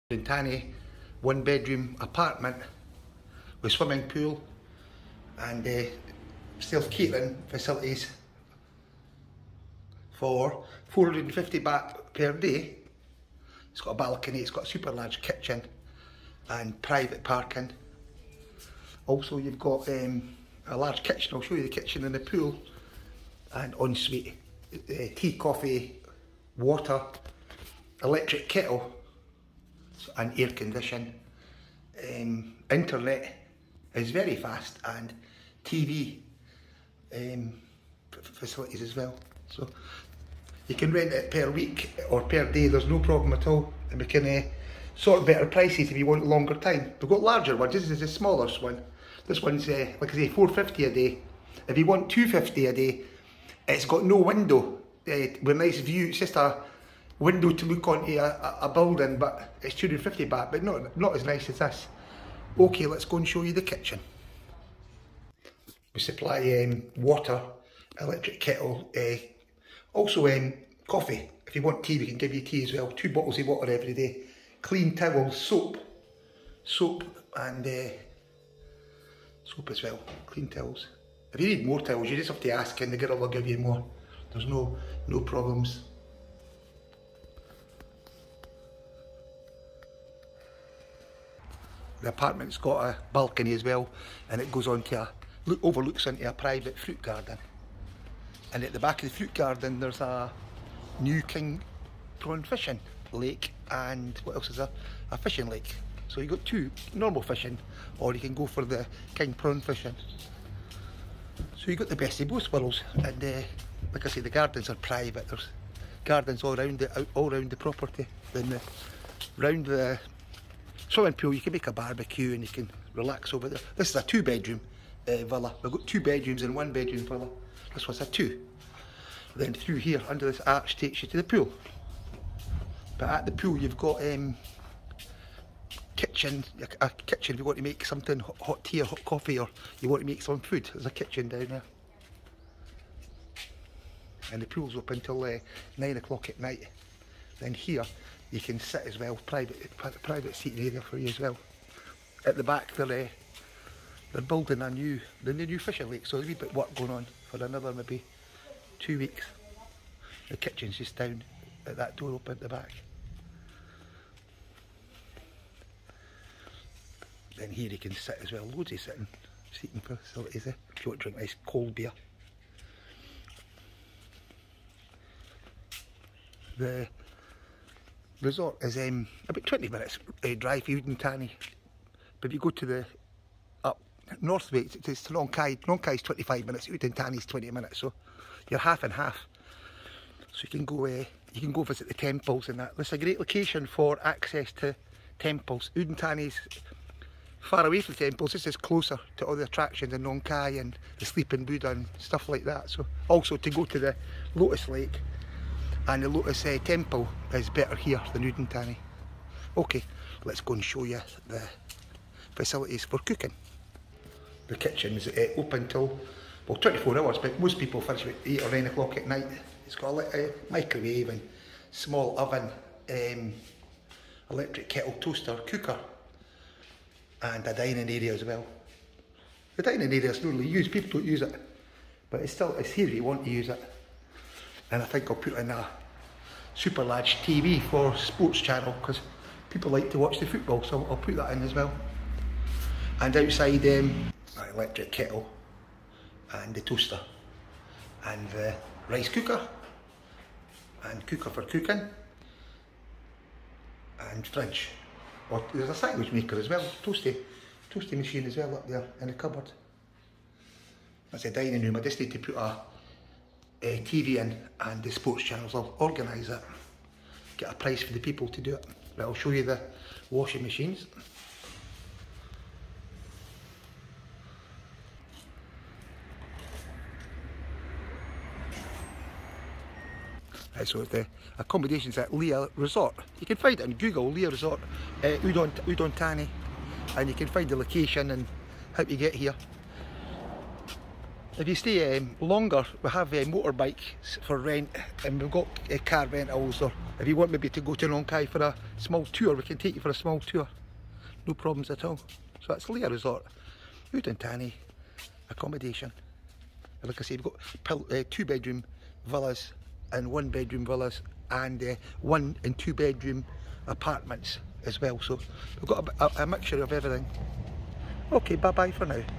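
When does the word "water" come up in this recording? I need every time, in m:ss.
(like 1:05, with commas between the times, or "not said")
0:26, 1:06, 1:13.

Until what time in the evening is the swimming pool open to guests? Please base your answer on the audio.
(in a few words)
9 o'clock.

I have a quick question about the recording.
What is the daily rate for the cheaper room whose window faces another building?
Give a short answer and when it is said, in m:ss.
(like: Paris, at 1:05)
250 baht, at 0:52.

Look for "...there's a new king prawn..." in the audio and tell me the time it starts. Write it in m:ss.
1:39.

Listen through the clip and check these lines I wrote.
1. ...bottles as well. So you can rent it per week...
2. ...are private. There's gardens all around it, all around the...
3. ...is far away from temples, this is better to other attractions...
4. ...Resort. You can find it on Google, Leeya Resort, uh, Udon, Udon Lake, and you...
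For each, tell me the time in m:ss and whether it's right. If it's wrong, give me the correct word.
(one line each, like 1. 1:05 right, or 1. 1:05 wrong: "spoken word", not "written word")
1. 0:38 wrong: "facilities", not "bottles"
2. 1:54 right
3. 3:16 wrong: "closer", not "better"
4. 4:42 wrong: "Thani", not "Lake".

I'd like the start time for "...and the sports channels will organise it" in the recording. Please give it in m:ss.
4:24.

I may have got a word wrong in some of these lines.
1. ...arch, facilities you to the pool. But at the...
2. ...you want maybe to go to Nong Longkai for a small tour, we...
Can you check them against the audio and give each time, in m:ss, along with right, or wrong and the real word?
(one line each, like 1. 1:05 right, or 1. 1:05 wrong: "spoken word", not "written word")
1. 2:10 wrong: "takes", not "facilities"
2. 4:57 wrong: "Khai", not "Longkai".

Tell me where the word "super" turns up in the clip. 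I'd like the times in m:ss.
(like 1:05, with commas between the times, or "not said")
0:14, 3:56.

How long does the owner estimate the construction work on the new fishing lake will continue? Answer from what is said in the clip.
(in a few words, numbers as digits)
2 weeks.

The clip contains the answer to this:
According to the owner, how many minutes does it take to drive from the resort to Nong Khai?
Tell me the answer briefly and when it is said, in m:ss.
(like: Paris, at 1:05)
25 minutes, at 3:06.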